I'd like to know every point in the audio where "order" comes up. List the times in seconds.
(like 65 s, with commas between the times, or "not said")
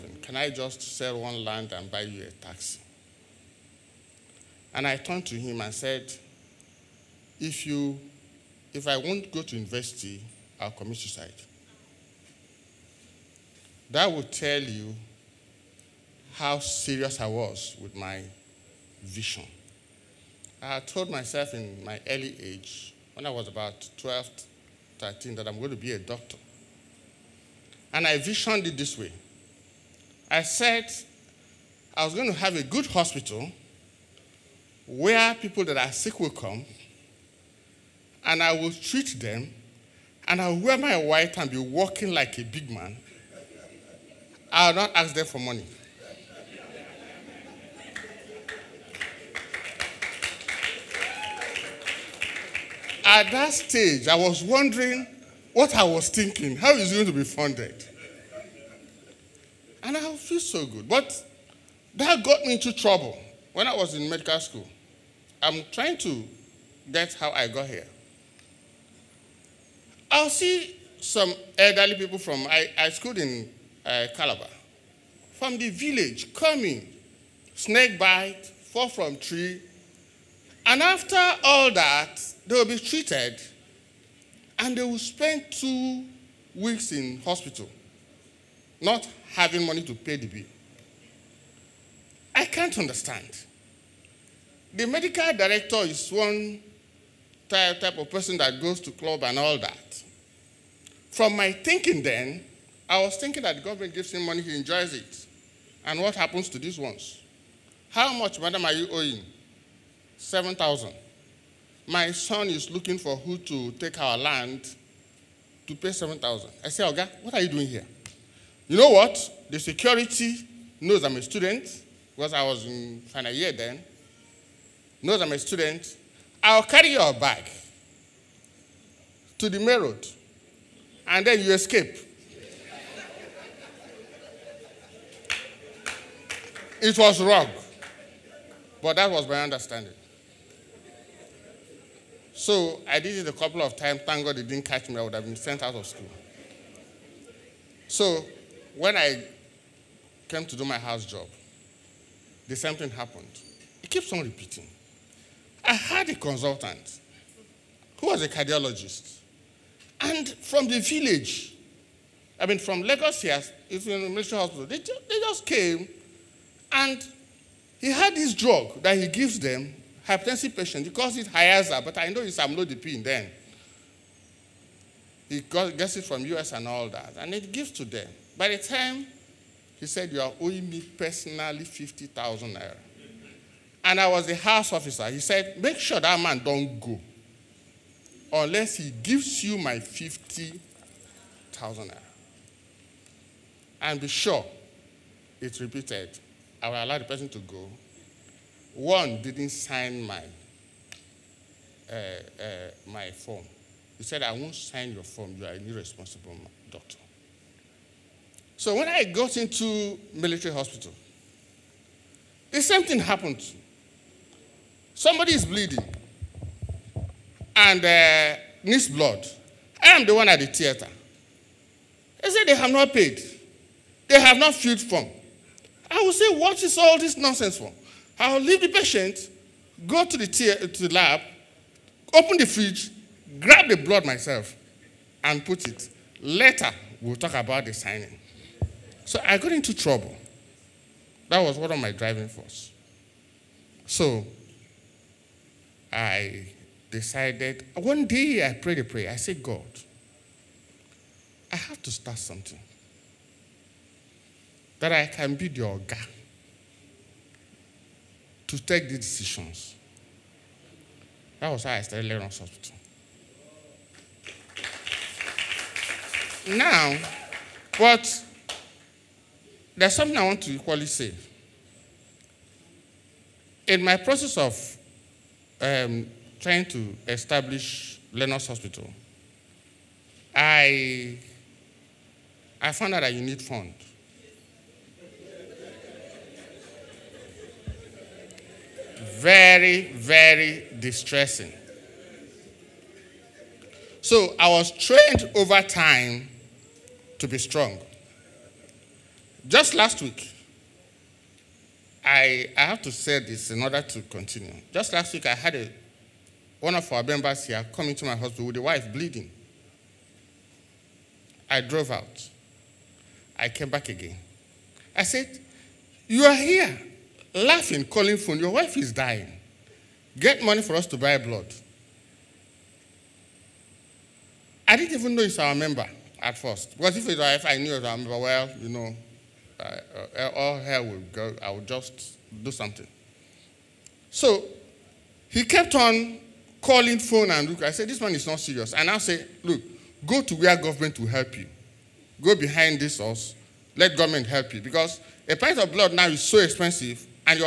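303 s.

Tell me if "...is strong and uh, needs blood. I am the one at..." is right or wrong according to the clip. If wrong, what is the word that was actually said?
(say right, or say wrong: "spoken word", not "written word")
wrong: "bleeding", not "strong".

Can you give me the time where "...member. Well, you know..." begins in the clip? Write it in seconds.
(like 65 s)
327 s.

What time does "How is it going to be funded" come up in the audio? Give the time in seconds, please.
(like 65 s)
56 s.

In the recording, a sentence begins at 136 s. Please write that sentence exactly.
it was wrong, but that was my understanding.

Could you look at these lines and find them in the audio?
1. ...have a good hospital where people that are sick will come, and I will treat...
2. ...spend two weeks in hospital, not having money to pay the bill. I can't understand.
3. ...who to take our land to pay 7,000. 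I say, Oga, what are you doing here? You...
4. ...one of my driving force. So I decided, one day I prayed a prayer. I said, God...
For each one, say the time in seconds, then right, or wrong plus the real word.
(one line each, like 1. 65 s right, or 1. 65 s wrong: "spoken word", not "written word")
1. 32 s right
2. 84 s right
3. 113 s right
4. 241 s right.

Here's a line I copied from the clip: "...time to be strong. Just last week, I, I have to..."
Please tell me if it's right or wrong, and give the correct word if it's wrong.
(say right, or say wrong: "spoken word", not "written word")
right.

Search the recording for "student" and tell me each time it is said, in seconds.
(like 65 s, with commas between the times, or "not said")
121 s, 125 s.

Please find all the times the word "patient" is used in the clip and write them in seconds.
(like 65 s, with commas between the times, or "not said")
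170 s, 228 s.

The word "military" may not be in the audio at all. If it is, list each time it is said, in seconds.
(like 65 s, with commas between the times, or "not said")
164 s, 210 s.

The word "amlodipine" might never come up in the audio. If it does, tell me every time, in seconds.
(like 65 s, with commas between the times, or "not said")
172 s.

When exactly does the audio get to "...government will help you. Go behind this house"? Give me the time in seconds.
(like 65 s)
340 s.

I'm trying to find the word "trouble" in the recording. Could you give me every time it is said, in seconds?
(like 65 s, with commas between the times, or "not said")
62 s, 239 s.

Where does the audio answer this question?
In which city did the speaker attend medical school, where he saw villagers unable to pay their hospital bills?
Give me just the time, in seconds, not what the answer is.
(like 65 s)
74 s.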